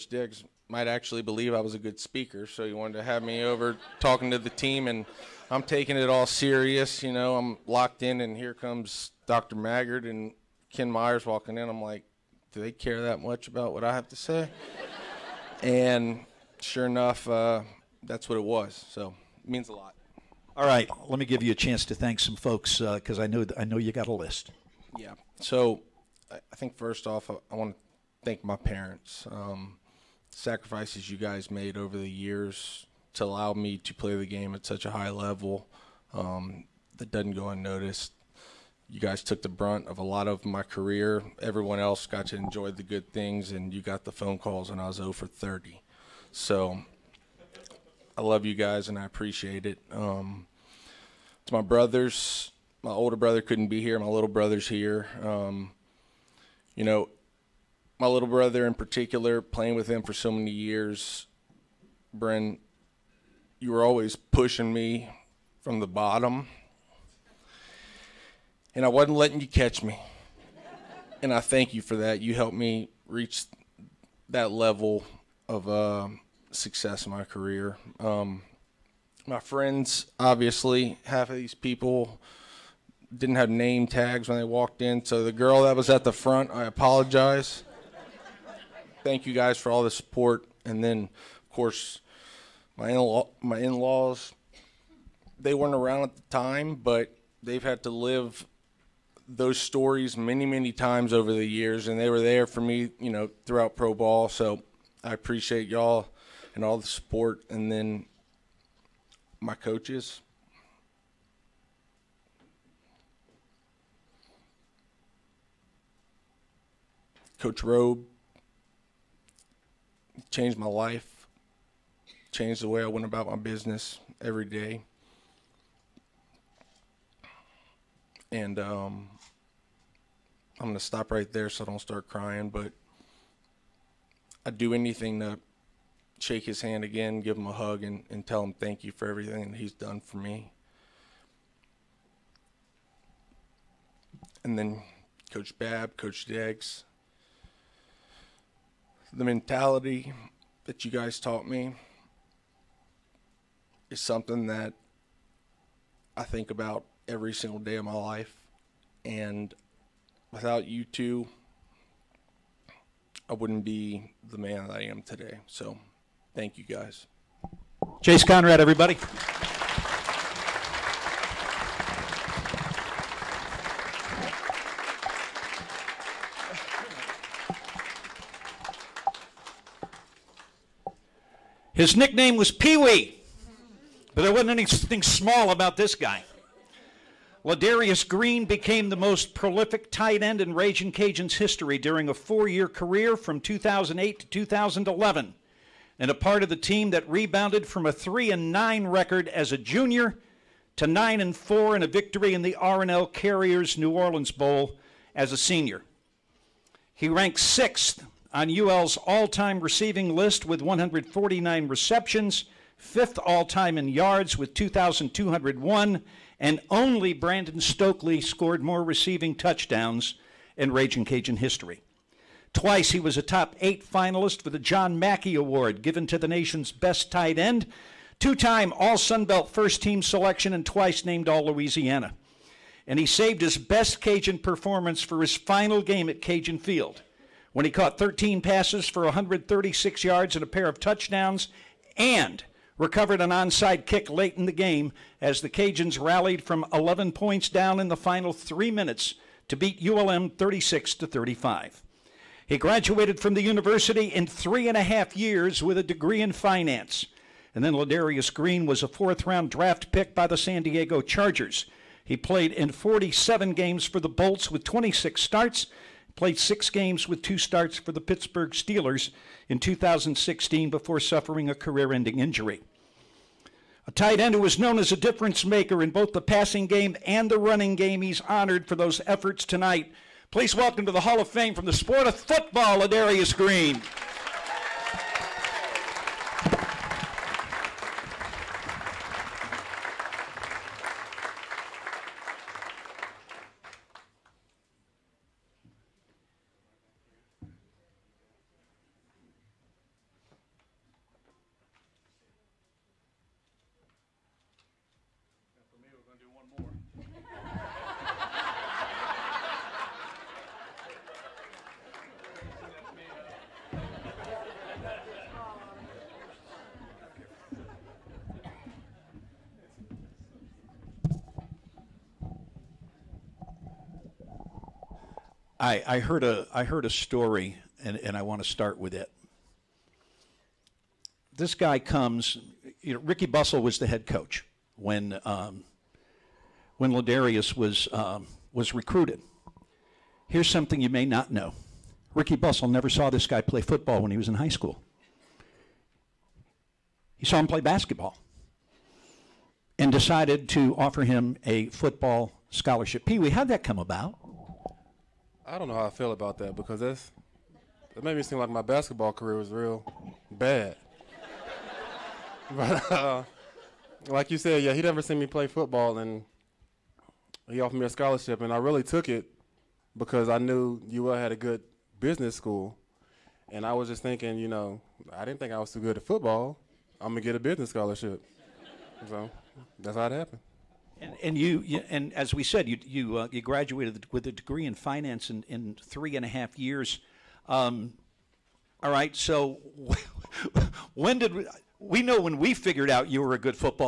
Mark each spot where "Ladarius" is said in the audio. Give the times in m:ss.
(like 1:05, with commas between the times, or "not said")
3:07, 4:17, 4:42, 5:36.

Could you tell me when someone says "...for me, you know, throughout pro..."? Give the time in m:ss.
1:42.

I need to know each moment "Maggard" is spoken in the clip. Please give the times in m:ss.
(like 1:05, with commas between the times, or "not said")
0:09.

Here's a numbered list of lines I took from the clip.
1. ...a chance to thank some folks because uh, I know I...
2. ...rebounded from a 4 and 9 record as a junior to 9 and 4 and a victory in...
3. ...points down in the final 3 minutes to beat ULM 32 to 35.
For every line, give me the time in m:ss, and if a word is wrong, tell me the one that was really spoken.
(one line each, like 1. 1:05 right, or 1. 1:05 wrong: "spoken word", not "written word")
1. 0:21 right
2. 3:17 wrong: "3", not "4"
3. 4:07 wrong: "36", not "32".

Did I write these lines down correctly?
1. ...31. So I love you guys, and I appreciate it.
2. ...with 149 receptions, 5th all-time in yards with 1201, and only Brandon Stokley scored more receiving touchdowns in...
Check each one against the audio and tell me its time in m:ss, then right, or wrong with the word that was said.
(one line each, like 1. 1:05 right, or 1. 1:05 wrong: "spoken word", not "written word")
1. 0:45 wrong: "30", not "31"
2. 3:30 wrong: "2201", not "1201".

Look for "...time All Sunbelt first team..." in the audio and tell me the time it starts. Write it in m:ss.
3:48.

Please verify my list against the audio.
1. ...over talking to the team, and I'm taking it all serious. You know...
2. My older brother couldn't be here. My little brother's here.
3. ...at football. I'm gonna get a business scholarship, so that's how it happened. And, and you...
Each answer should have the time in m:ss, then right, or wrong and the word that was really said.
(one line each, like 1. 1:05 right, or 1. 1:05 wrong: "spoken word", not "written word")
1. 0:03 right
2. 0:52 right
3. 6:15 right.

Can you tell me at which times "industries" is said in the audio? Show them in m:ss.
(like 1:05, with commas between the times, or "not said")
not said.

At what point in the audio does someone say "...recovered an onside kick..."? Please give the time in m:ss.
4:02.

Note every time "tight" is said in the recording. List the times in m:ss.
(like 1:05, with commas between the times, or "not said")
3:09, 3:47, 4:33.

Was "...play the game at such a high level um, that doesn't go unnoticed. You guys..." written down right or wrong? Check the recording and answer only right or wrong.
right.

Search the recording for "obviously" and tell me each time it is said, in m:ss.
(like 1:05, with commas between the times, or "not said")
1:20.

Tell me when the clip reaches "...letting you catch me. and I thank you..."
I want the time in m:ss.
1:09.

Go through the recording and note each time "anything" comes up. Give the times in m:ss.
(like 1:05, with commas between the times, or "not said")
2:14, 3:04.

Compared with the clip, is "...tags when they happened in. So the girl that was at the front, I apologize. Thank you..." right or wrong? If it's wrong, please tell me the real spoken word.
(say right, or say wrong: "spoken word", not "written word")
wrong: "walked", not "happened".